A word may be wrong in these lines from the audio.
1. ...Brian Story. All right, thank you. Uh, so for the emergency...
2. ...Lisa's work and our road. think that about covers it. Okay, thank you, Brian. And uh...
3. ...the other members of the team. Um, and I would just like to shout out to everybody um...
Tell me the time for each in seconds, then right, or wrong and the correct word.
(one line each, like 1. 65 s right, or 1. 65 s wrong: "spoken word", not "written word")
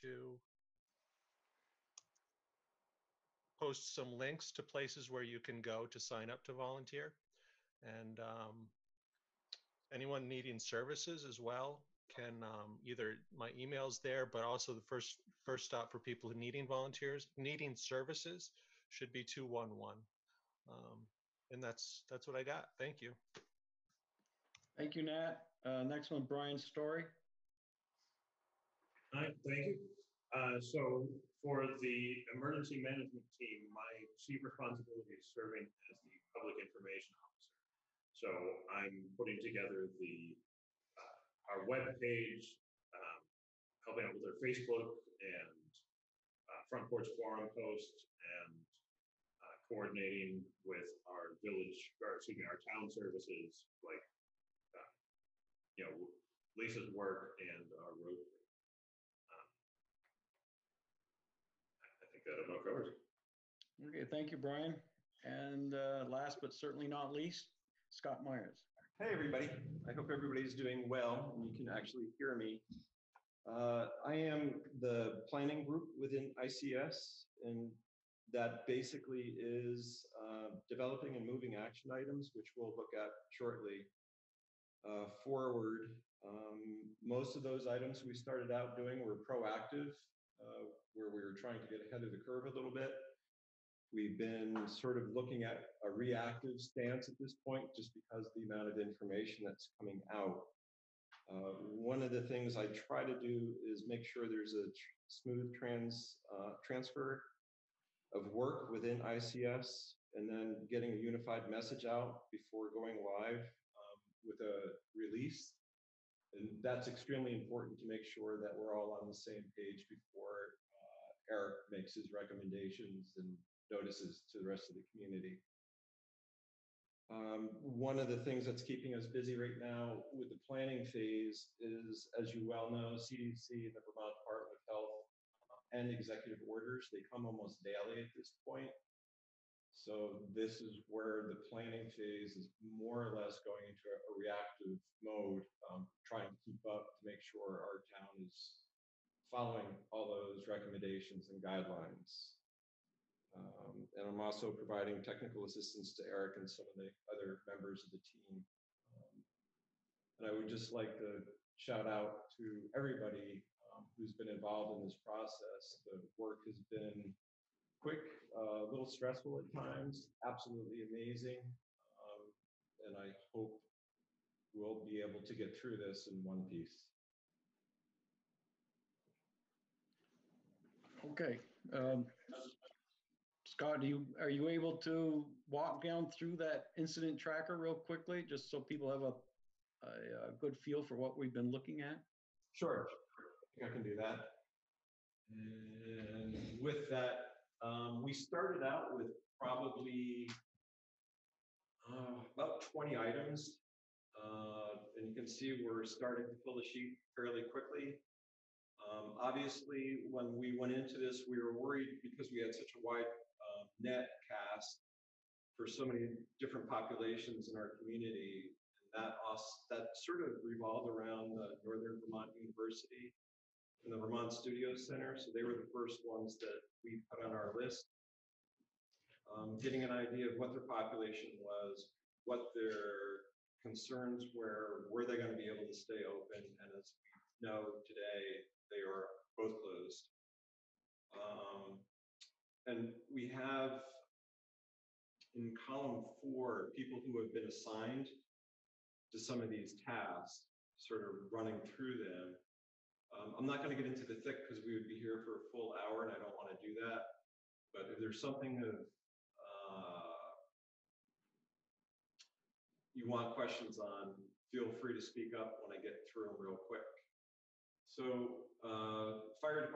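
1. 26 s right
2. 56 s right
3. 156 s right.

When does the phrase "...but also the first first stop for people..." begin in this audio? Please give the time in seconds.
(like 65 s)
14 s.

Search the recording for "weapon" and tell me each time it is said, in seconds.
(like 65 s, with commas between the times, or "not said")
not said.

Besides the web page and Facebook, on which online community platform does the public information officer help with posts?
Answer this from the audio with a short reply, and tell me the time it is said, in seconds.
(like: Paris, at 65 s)
Front Porch Forum, at 46 s.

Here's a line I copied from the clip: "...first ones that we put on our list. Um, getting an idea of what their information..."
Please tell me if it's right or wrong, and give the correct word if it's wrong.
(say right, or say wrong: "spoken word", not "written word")
wrong: "population", not "information".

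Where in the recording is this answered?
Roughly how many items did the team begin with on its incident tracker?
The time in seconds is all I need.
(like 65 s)
202 s.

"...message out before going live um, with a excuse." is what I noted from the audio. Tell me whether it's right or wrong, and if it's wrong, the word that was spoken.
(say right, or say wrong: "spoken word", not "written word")
wrong: "release", not "excuse".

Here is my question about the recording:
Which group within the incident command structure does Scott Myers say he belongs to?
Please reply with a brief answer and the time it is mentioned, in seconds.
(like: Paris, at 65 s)
Planning group, at 75 s.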